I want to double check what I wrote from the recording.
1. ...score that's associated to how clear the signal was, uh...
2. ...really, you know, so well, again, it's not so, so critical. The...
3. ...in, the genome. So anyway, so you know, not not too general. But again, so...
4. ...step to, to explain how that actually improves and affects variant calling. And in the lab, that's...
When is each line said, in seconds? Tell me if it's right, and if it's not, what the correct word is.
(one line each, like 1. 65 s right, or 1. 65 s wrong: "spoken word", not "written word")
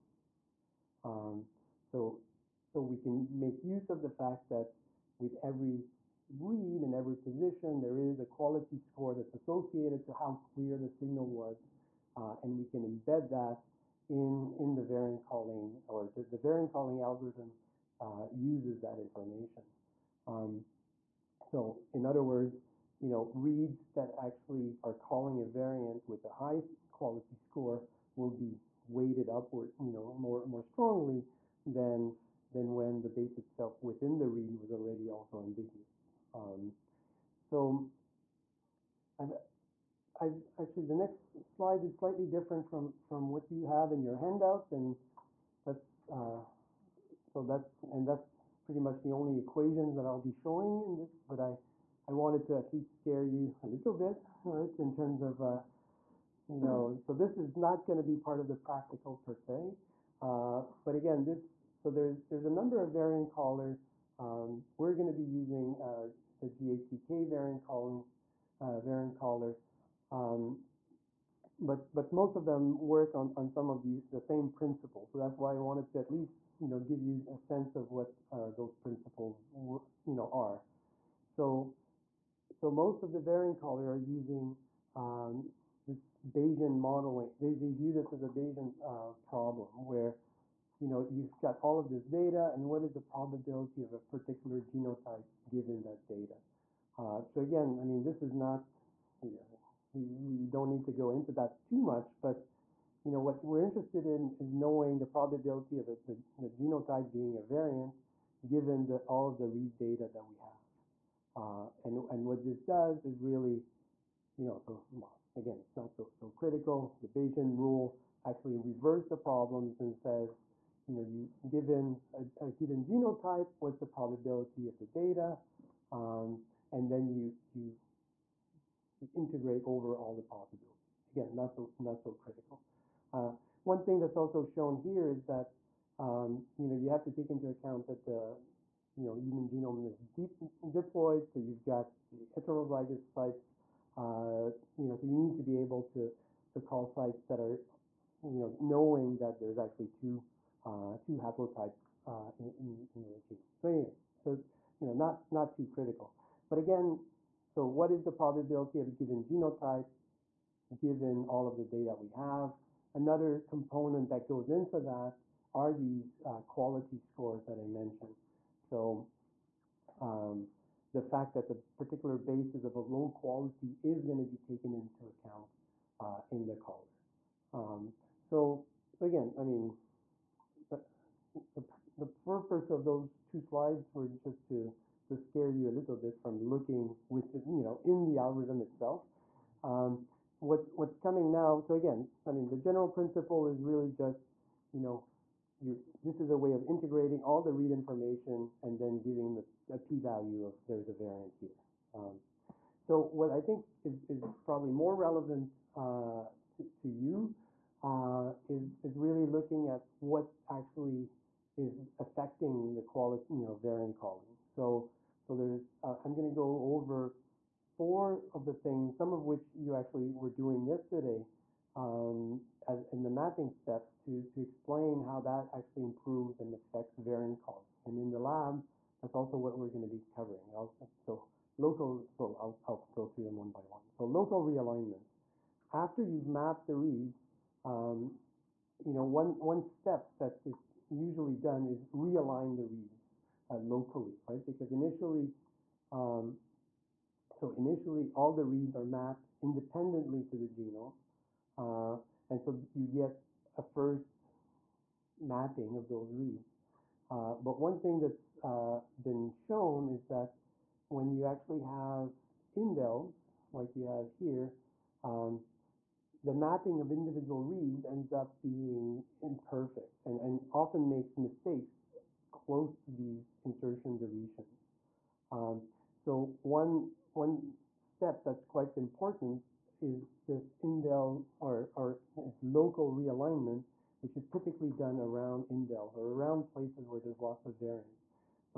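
1. 8 s right
2. 113 s right
3. 152 s wrong: "critical", not "general"
4. 223 s right.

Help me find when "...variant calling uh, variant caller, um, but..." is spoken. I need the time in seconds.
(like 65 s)
67 s.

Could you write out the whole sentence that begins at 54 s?
In terms of uh, you know, so this is not going to be part of the practical per se.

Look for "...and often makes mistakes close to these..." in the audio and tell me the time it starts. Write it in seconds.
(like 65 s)
270 s.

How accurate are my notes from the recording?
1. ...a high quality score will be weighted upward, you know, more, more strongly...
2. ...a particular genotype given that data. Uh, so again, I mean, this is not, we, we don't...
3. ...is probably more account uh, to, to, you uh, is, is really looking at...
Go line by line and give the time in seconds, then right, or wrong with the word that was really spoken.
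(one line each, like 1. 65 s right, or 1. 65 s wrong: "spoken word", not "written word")
1. 26 s right
2. 93 s right
3. 204 s wrong: "relevant", not "account".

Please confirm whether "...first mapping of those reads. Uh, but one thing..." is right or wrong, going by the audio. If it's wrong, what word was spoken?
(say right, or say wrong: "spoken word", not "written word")
right.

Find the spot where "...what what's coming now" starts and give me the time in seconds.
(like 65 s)
190 s.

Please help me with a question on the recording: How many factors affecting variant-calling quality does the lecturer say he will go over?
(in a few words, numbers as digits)
4.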